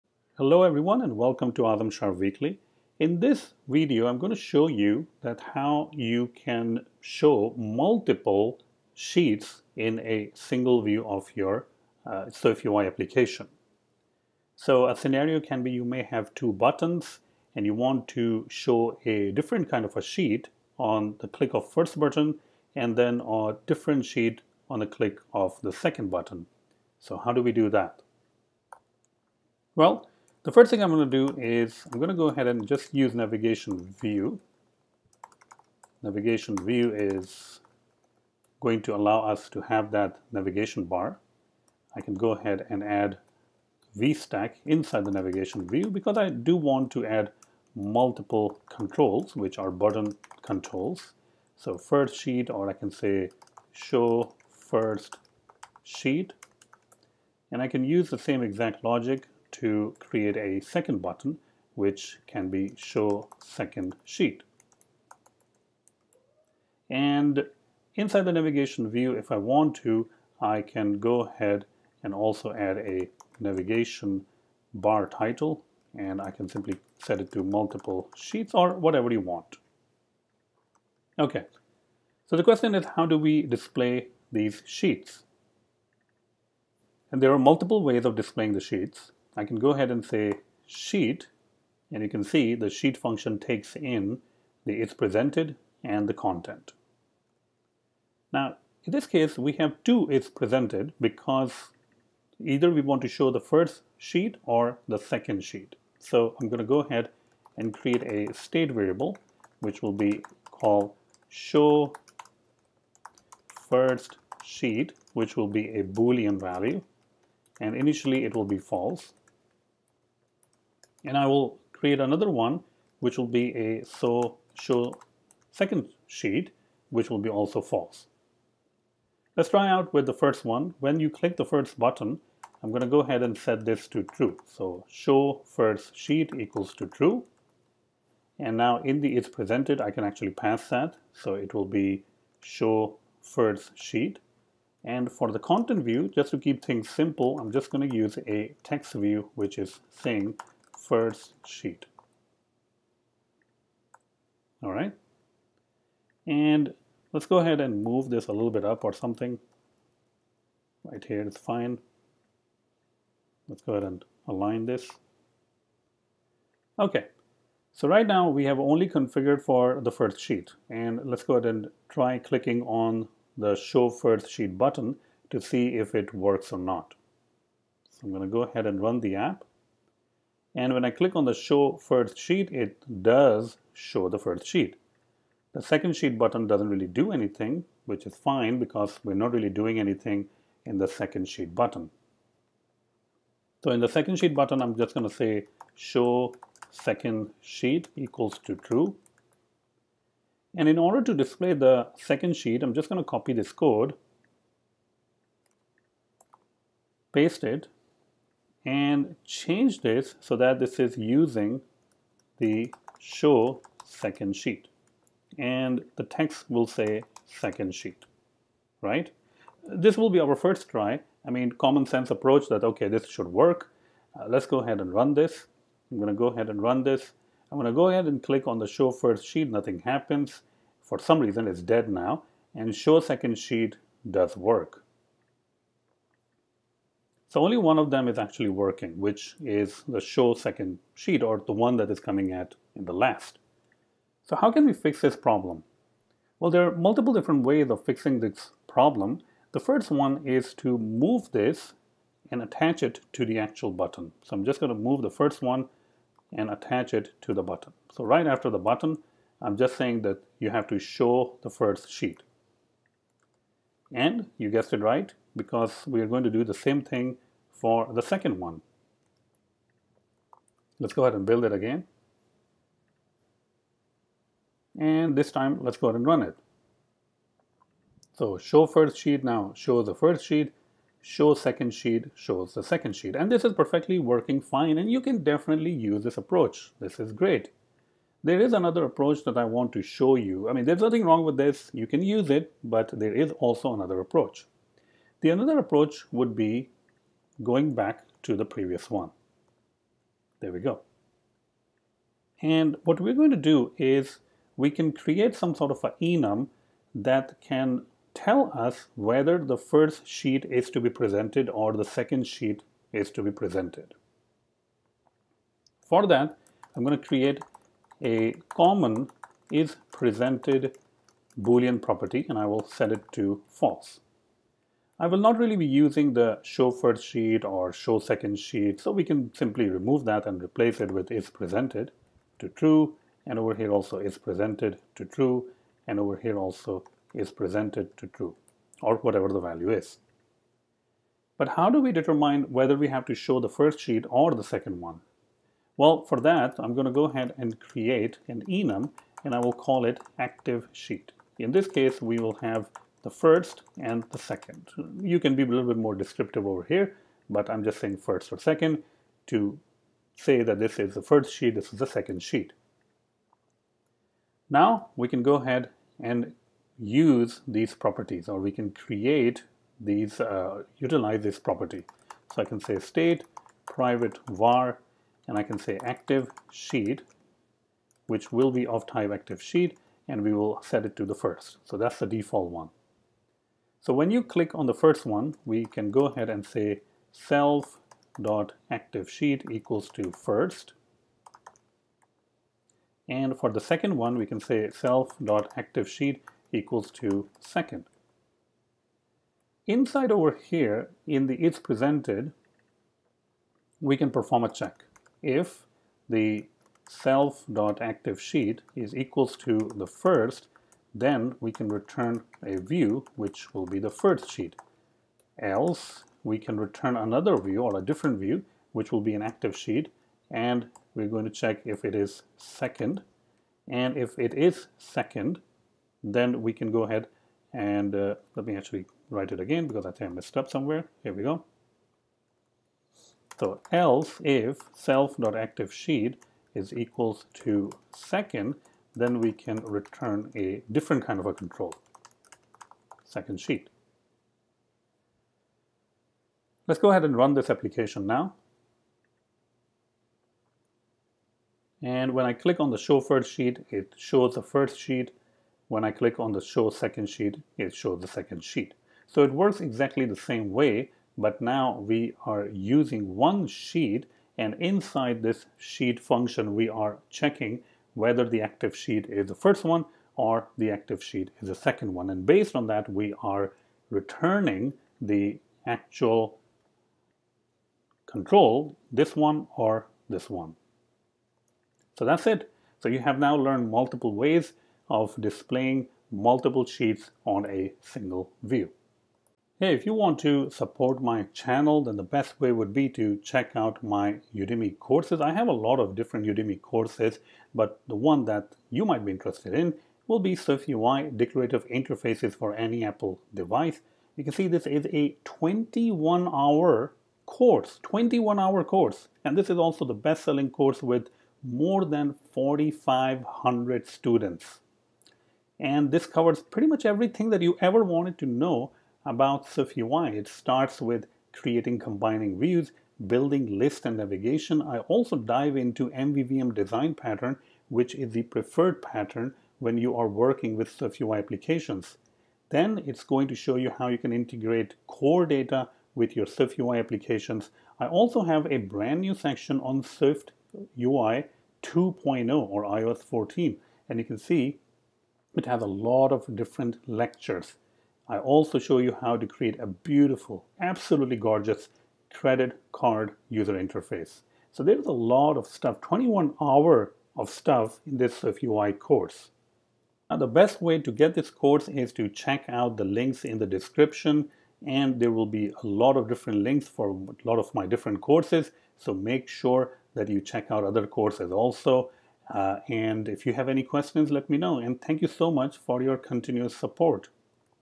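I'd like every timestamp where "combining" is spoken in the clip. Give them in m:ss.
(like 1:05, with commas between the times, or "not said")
8:41.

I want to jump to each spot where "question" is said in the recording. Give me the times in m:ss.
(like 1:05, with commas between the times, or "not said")
1:22, 9:33.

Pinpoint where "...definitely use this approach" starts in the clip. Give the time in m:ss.
4:45.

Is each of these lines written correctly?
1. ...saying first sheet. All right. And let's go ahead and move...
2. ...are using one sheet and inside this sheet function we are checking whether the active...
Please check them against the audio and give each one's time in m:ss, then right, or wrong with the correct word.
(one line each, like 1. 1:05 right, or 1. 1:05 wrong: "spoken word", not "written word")
1. 2:29 right
2. 7:42 right.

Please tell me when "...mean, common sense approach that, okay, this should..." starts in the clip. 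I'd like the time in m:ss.
3:41.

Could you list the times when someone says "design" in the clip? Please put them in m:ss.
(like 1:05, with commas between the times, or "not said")
8:46.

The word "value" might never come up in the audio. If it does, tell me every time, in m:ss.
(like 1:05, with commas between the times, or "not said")
1:56, 5:39.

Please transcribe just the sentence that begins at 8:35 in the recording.
And this covers pretty much everything that you ever wanted to know about SwiftUI.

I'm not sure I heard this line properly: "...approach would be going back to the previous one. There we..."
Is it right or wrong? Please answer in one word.
right.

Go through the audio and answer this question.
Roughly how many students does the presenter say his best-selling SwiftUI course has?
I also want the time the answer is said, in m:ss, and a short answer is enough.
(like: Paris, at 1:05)
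4,500, at 8:32.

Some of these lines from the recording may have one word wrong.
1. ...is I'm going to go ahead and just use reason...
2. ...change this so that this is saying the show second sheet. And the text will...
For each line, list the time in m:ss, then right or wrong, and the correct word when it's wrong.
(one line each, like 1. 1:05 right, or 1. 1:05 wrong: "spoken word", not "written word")
1. 0:31 wrong: "navigation", not "reason"
2. 3:29 wrong: "using", not "saying".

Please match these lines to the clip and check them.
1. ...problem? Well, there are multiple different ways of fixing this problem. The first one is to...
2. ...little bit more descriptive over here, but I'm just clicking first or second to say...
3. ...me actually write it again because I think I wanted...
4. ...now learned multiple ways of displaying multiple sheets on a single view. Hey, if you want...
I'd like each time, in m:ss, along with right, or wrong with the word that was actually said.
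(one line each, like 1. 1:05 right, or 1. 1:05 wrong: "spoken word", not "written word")
1. 4:05 right
2. 5:55 wrong: "saying", not "clicking"
3. 7:08 wrong: "messed", not "wanted"
4. 8:03 right.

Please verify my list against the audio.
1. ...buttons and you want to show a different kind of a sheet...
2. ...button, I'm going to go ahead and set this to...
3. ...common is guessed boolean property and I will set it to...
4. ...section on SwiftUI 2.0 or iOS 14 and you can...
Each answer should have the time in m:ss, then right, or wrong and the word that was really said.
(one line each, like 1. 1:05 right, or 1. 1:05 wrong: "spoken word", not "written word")
1. 0:16 right
2. 2:11 right
3. 5:18 wrong: "presented", not "guessed"
4. 8:59 right.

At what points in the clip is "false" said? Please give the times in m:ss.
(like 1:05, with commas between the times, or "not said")
1:58, 2:07, 5:23.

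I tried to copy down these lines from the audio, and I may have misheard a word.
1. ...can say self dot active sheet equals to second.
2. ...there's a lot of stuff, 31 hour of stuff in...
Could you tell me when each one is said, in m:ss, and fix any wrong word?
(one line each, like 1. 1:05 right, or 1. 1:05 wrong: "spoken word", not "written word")
1. 6:34 right
2. 9:14 wrong: "21", not "31".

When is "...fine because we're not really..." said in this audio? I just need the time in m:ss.
3:08.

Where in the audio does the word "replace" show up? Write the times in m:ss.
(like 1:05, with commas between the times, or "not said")
5:30.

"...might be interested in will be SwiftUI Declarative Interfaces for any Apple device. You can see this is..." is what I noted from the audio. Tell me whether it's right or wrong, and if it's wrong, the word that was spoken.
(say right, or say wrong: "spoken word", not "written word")
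right.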